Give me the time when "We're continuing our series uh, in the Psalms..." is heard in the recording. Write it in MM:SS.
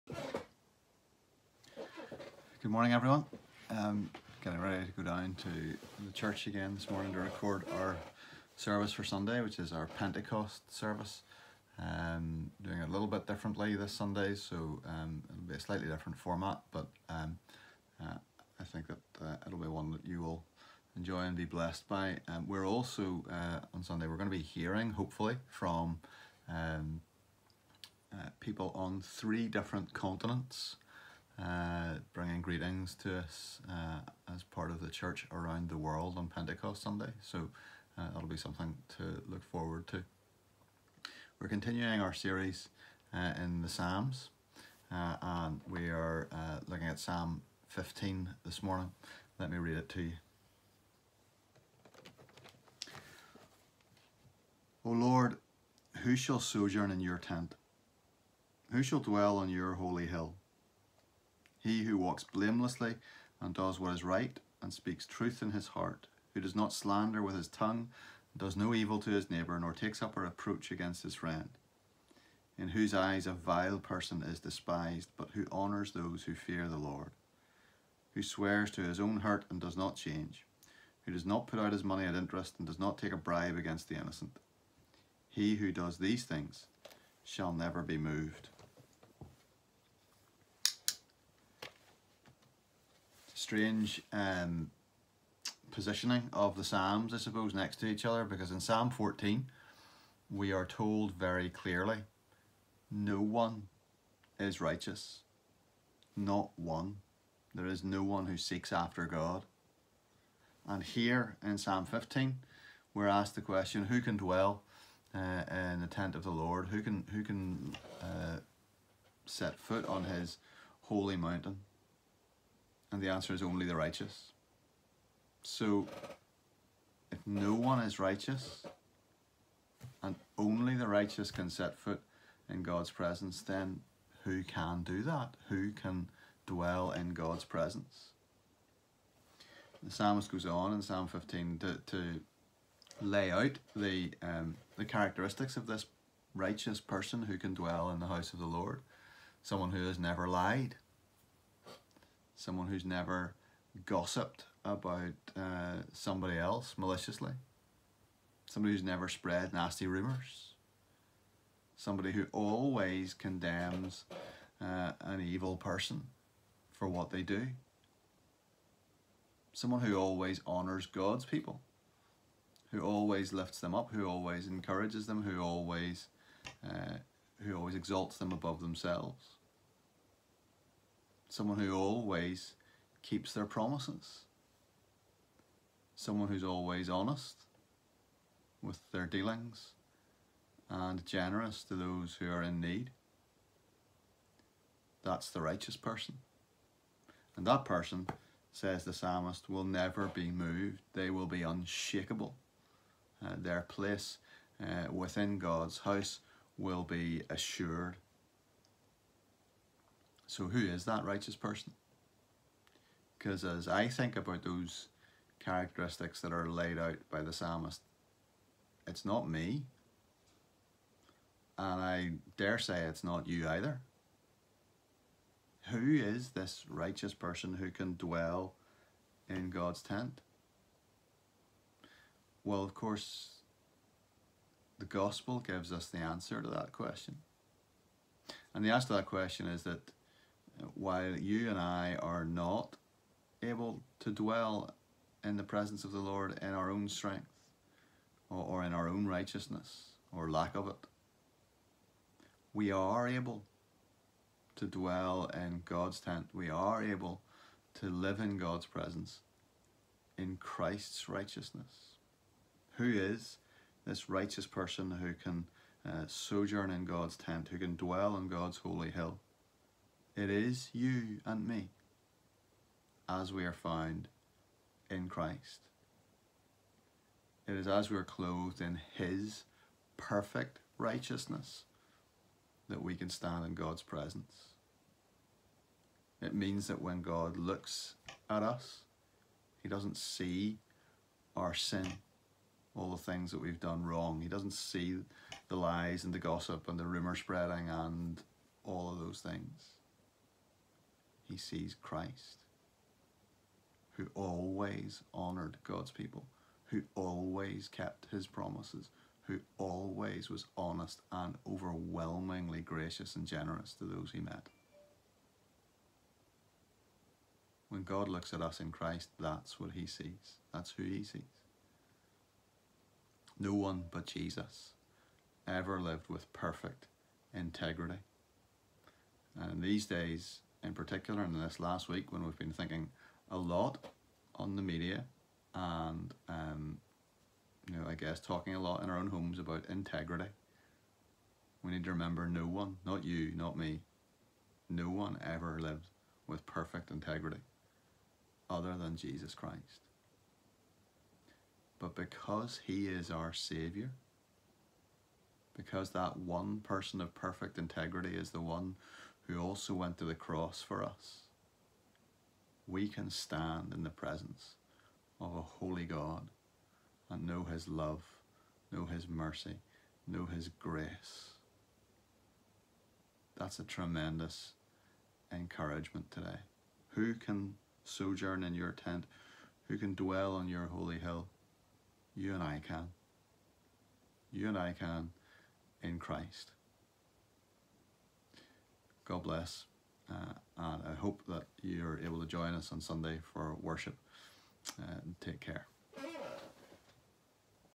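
00:41.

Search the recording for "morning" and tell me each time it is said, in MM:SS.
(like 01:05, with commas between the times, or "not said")
00:02, 00:06, 00:48.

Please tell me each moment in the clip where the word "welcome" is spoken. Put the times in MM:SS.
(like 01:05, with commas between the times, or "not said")
not said.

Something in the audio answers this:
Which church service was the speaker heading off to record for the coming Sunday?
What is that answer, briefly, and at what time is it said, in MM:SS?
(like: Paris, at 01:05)
Pentecost service, at 00:09.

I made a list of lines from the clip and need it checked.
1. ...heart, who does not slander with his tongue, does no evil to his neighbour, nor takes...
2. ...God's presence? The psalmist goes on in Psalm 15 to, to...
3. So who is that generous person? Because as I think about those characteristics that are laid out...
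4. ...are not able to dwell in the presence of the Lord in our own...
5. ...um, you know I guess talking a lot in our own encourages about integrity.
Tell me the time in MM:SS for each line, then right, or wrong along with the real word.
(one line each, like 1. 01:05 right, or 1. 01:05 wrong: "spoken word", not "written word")
1. 01:05 right
2. 02:17 right
3. 03:30 wrong: "righteous", not "generous"
4. 04:02 right
5. 05:36 wrong: "homes", not "encourages".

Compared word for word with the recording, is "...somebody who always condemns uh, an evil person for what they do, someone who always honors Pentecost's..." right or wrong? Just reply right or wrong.
wrong.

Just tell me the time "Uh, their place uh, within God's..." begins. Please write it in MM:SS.
03:23.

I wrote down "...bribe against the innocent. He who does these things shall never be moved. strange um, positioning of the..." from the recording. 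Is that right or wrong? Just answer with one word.
right.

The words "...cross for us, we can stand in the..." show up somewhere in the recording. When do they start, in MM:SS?
06:00.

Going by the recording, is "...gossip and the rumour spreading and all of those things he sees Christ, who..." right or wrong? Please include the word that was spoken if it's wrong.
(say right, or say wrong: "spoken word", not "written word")
right.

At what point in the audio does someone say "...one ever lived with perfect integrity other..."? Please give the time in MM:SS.
05:44.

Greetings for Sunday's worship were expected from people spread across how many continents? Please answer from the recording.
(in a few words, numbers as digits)
3.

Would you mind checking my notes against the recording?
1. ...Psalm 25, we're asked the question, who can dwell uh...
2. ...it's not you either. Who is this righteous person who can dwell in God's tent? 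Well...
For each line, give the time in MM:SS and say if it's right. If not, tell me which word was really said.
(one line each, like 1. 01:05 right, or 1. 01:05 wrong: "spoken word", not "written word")
1. 01:51 wrong: "15", not "25"
2. 03:42 right.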